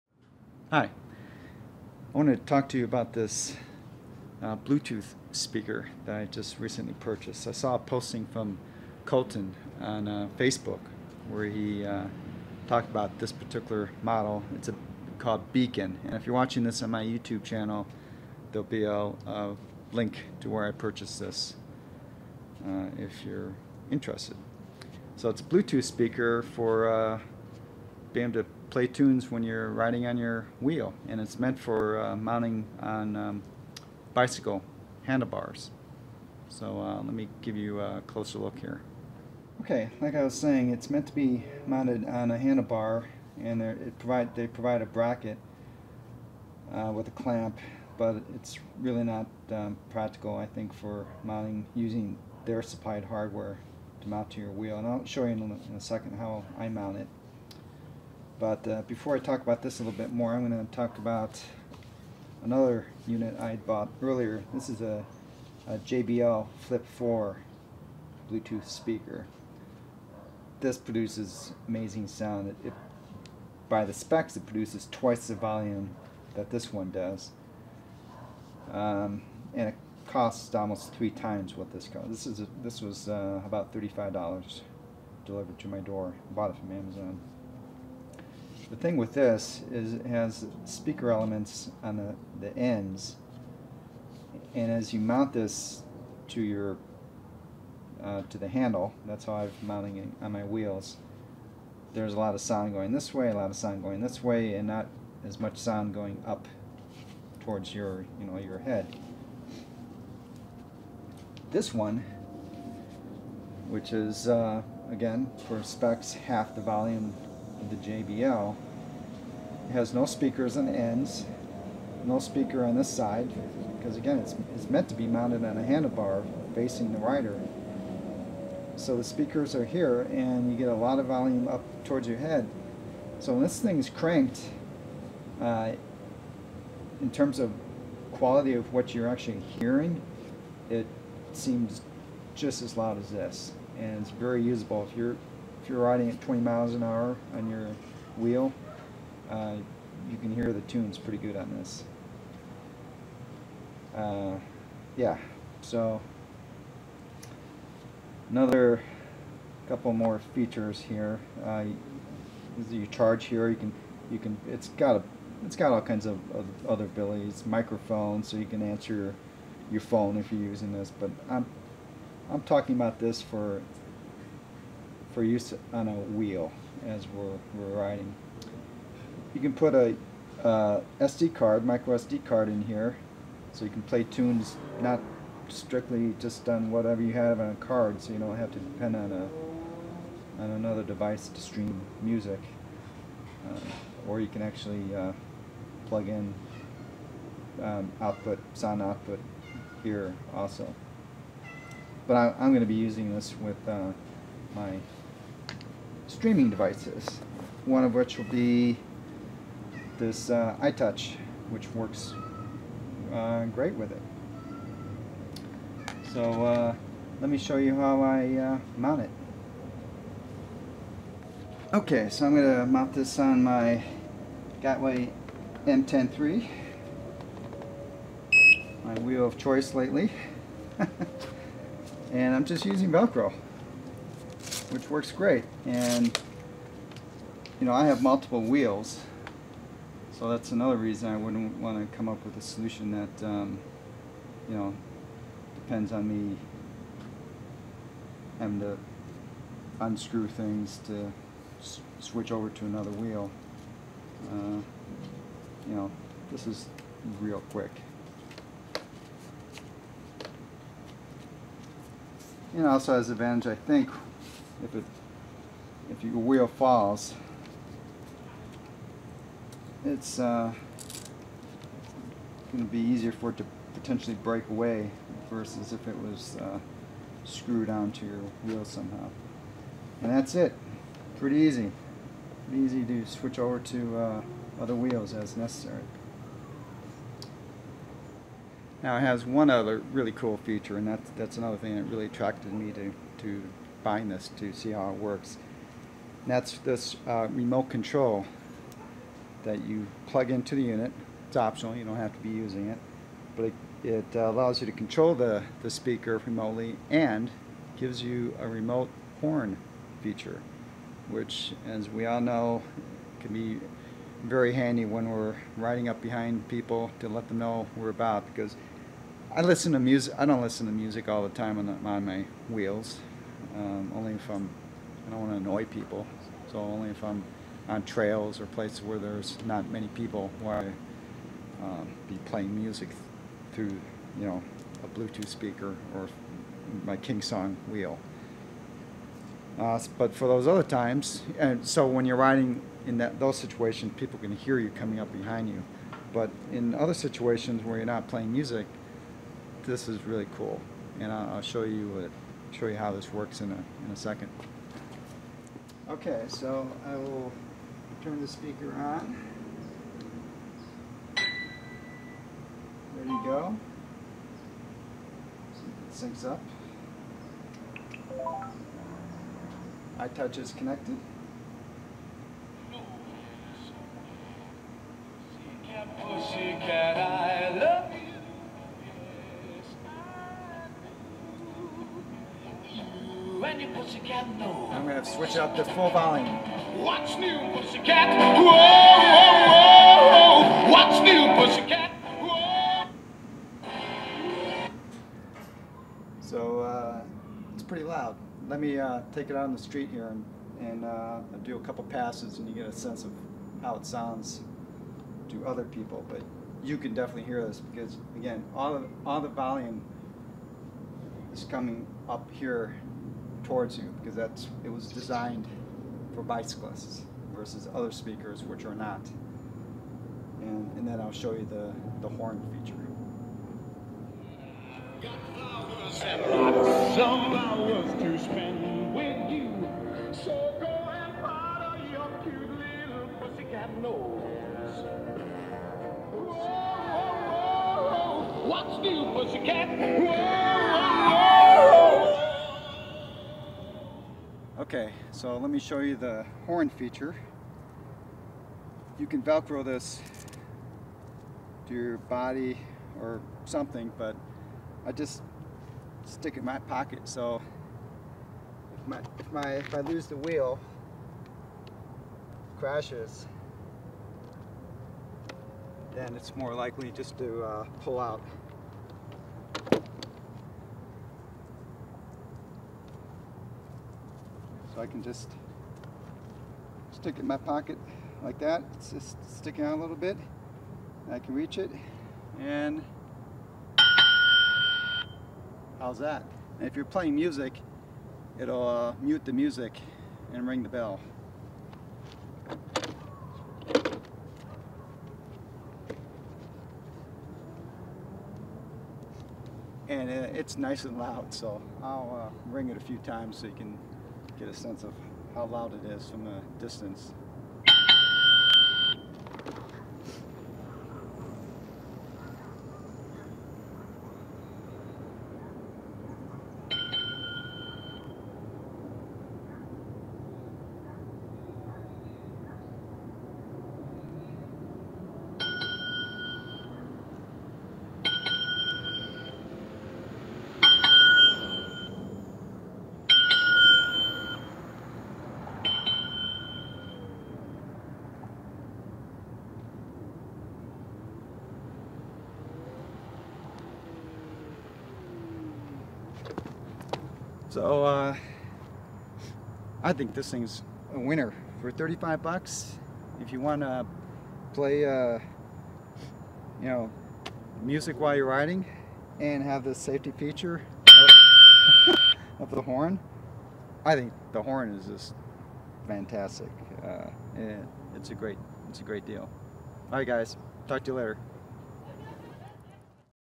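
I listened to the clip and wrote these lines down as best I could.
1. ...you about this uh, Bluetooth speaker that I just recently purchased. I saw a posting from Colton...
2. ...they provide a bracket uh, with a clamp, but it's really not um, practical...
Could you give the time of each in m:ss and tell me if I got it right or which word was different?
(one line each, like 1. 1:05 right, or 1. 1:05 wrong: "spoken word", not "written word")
1. 0:02 right
2. 0:44 right.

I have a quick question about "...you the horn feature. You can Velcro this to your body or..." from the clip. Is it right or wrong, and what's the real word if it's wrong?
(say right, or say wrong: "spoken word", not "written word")
right.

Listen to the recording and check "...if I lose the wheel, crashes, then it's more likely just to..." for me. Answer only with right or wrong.
right.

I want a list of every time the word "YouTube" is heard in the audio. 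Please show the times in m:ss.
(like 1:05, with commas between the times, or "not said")
0:17.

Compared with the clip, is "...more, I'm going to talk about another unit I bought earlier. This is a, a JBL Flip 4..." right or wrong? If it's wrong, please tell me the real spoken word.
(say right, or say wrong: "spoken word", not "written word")
right.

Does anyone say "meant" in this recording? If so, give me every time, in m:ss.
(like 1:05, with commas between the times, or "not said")
0:31, 0:40, 2:04.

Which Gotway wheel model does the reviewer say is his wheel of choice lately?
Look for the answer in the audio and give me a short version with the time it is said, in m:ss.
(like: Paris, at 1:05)
M10 III, at 3:45.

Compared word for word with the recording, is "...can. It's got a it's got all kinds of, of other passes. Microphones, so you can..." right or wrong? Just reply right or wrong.
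wrong.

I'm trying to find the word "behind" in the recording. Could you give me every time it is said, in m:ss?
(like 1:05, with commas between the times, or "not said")
5:16, 5:45.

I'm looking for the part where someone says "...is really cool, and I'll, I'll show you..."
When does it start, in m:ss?
5:49.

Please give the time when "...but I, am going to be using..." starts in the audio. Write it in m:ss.
3:22.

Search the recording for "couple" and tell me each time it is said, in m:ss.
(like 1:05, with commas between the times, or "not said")
2:39, 6:41.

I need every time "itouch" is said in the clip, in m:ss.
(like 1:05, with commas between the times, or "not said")
3:30, 6:09.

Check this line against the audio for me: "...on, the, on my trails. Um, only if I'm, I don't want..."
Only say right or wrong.
wrong.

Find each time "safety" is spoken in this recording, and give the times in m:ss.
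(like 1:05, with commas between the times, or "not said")
9:19.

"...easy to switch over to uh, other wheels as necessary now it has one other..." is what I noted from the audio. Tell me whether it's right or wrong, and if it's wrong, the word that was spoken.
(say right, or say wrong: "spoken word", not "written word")
right.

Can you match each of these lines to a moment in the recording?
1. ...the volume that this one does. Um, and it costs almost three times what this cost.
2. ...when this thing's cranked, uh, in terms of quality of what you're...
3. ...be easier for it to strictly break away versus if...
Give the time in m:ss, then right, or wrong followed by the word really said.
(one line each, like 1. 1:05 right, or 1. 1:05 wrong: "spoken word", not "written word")
1. 1:15 right
2. 2:13 right
3. 4:32 wrong: "potentially", not "strictly".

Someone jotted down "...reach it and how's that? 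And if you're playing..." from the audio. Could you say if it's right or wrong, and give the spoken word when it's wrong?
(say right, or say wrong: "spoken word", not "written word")
right.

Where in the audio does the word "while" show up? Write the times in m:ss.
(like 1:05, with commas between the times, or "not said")
9:17.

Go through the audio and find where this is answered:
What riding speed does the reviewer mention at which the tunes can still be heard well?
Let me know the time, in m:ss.
2:26.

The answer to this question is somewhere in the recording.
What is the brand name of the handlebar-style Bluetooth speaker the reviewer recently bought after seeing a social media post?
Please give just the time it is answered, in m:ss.
0:15.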